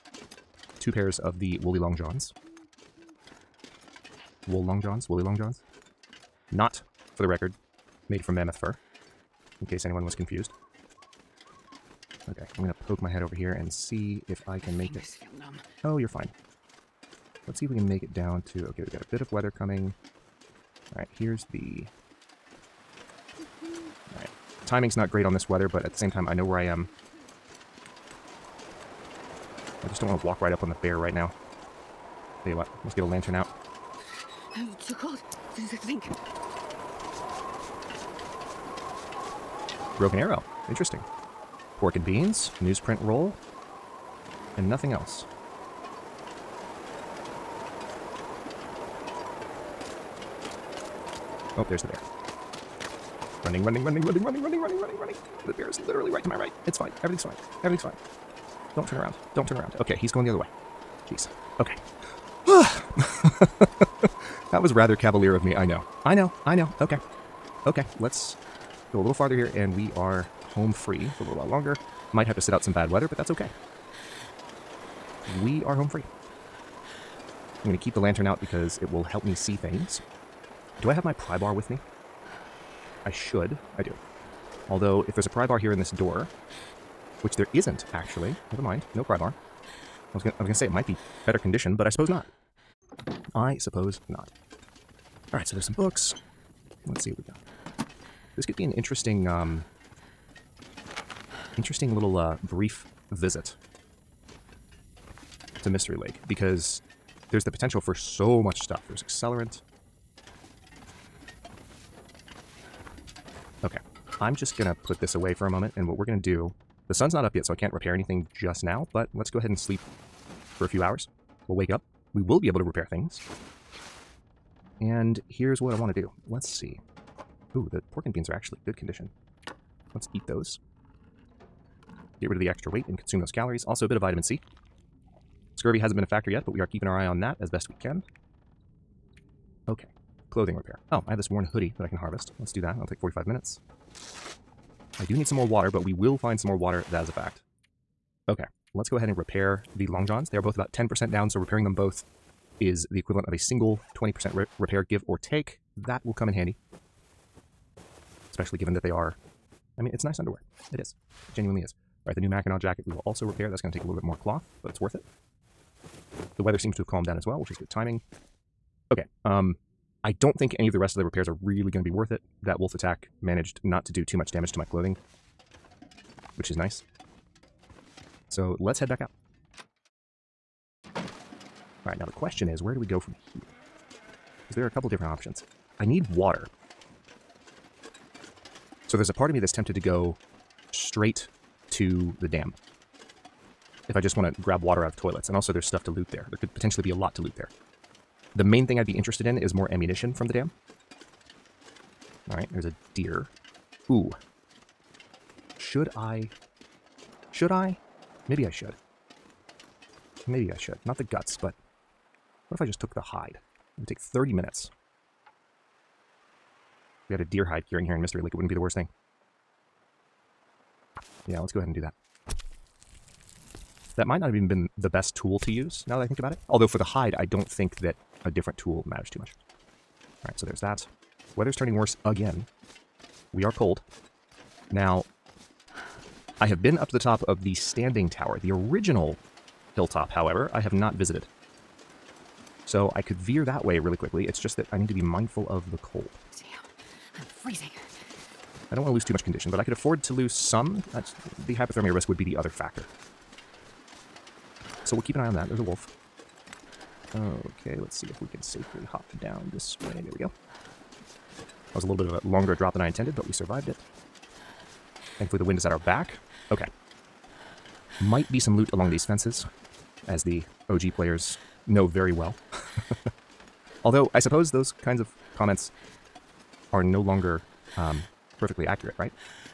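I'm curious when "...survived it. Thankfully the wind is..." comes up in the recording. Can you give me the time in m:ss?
4:23.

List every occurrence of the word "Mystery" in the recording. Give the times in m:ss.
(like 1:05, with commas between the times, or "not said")
1:45, 3:38.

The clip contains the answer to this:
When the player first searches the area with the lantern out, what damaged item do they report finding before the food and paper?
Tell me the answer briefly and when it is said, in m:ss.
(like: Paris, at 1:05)
Broken arrow, at 0:39.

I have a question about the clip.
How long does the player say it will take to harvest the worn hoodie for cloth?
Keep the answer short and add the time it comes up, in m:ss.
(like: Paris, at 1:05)
45 minutes, at 2:22.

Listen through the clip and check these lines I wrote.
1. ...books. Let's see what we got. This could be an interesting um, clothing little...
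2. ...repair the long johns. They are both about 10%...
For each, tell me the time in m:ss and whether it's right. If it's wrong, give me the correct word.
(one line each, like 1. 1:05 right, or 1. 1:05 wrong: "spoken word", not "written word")
1. 1:35 wrong: "interesting", not "clothing"
2. 2:29 right.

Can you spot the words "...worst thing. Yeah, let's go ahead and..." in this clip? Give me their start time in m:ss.
3:38.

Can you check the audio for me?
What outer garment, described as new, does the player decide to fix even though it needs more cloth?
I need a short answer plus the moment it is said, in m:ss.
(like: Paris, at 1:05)
Mackinaw jacket, at 2:42.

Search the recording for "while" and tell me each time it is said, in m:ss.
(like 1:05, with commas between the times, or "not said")
1:11.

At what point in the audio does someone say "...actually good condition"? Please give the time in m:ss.
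2:08.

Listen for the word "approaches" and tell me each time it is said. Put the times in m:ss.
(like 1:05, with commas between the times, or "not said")
not said.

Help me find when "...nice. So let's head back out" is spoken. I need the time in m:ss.
2:56.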